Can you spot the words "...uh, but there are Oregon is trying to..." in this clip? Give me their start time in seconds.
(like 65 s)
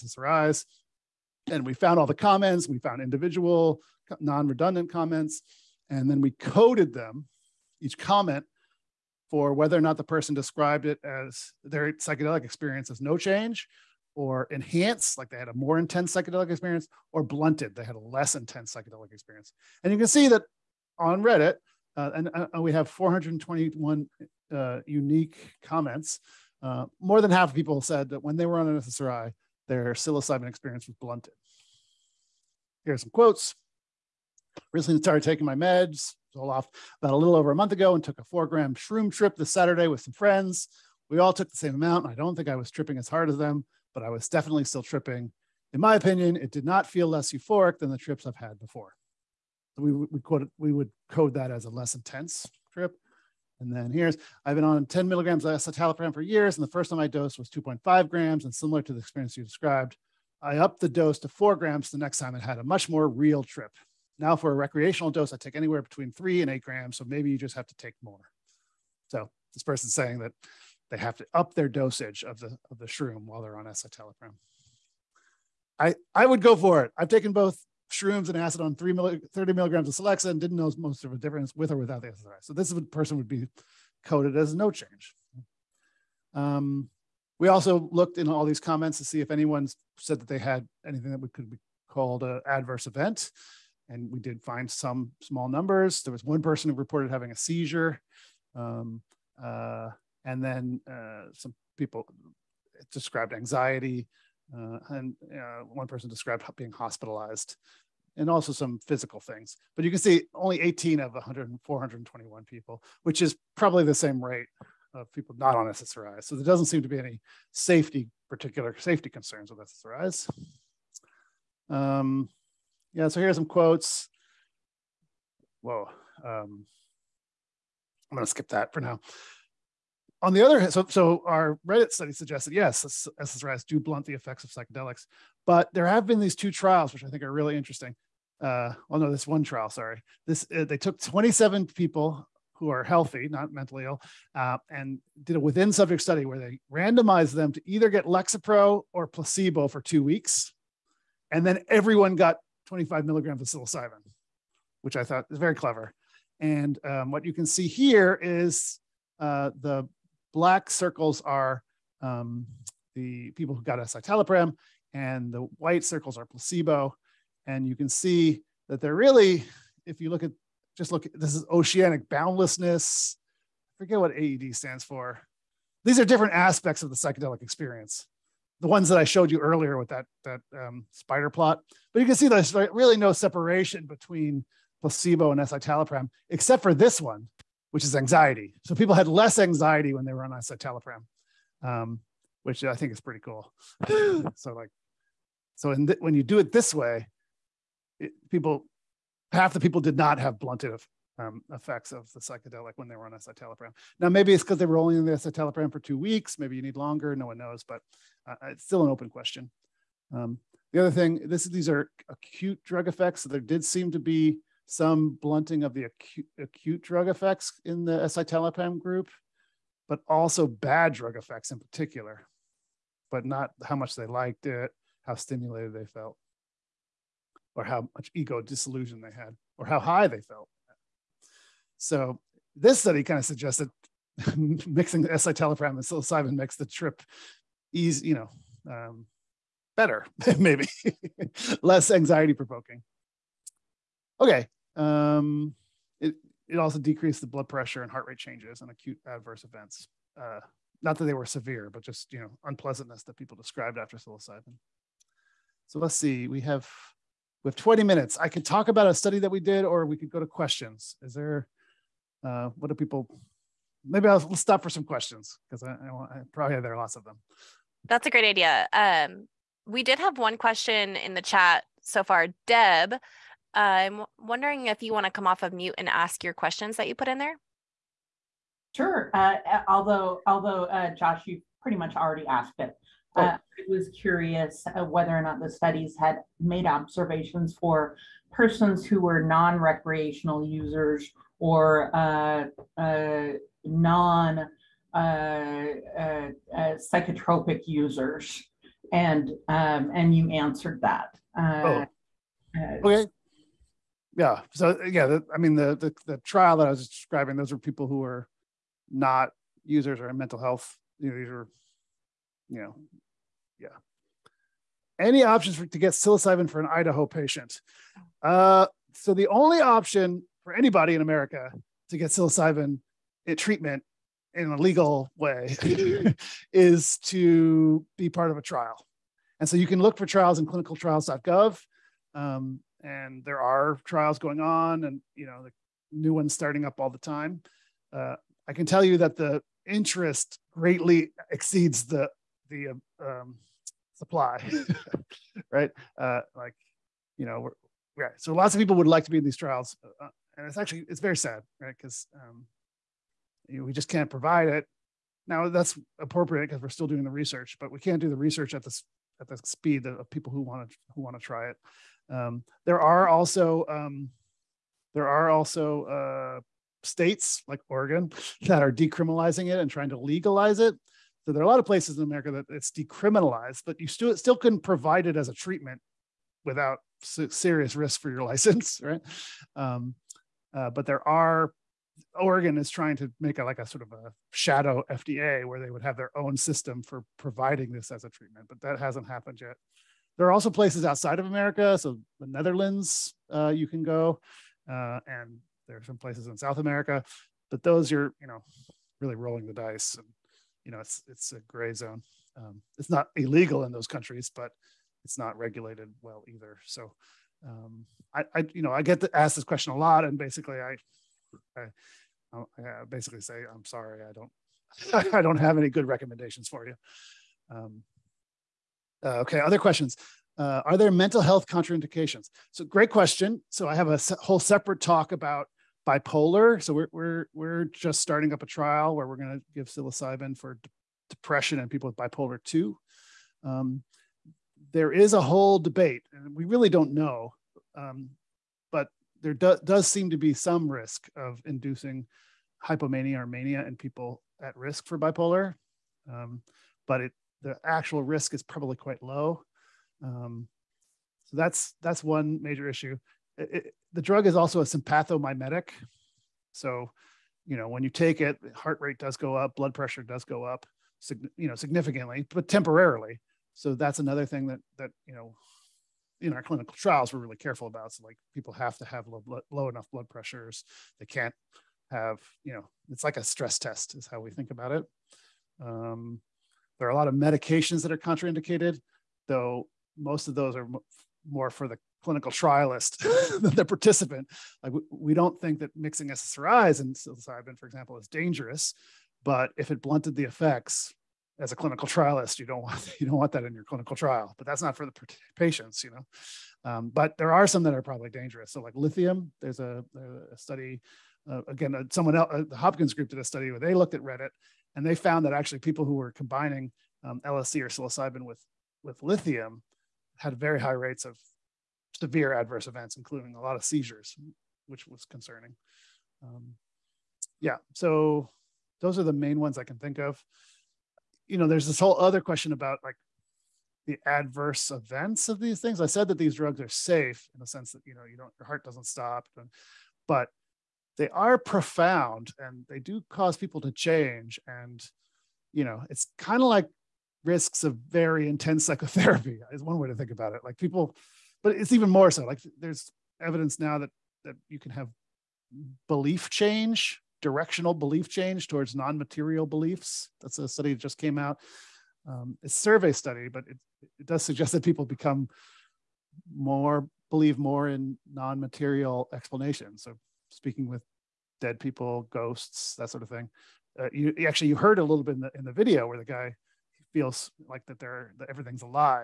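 380 s.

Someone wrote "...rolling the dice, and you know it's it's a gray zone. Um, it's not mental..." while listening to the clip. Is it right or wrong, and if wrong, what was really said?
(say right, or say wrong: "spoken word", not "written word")
wrong: "illegal", not "mental".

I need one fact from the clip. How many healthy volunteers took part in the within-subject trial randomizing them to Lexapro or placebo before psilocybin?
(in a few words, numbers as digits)
27.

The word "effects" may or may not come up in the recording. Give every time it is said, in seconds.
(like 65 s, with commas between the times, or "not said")
134 s, 201 s, 212 s, 217 s, 221 s, 490 s.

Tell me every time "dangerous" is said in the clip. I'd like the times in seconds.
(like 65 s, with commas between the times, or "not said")
488 s, 498 s.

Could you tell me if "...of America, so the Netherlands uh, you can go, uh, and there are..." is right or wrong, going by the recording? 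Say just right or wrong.
right.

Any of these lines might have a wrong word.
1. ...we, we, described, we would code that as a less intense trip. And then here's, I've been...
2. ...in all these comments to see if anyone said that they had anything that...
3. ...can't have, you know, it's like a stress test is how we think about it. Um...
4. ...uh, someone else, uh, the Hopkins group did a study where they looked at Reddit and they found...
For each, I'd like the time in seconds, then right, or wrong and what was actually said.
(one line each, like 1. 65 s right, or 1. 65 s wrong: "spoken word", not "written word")
1. 49 s wrong: "quoted", not "described"
2. 88 s right
3. 471 s right
4. 501 s right.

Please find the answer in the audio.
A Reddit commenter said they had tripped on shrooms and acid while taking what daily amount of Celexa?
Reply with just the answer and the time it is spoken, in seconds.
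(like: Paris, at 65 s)
30 milligrams, at 79 s.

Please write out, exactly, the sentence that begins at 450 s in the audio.
Um, so that's that's one major issue.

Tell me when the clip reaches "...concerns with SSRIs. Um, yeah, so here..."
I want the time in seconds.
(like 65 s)
119 s.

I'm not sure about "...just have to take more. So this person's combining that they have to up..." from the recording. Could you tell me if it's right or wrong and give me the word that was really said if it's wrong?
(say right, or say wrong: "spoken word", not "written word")
wrong: "saying", not "combining".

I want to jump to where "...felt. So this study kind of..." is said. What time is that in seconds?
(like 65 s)
230 s.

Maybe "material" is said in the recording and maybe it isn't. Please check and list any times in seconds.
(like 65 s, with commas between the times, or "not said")
548 s, 558 s.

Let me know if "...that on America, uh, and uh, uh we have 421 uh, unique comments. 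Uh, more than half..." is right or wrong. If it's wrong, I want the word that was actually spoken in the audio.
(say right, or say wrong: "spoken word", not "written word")
wrong: "Reddit", not "America".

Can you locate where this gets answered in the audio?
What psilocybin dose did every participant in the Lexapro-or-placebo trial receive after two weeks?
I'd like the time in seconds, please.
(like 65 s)
152 s.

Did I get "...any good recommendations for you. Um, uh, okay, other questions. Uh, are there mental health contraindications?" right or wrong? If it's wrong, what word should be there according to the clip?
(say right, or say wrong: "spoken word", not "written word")
right.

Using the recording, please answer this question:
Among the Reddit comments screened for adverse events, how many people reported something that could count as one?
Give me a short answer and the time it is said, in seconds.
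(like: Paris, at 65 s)
18, at 110 s.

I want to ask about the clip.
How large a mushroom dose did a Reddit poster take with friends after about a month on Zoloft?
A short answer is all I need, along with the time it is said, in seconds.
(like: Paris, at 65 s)
4 grams, at 38 s.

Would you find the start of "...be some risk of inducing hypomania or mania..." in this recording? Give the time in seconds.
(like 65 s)
440 s.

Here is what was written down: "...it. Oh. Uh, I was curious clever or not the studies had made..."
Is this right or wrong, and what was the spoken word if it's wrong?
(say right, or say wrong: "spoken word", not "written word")
wrong: "whether", not "clever".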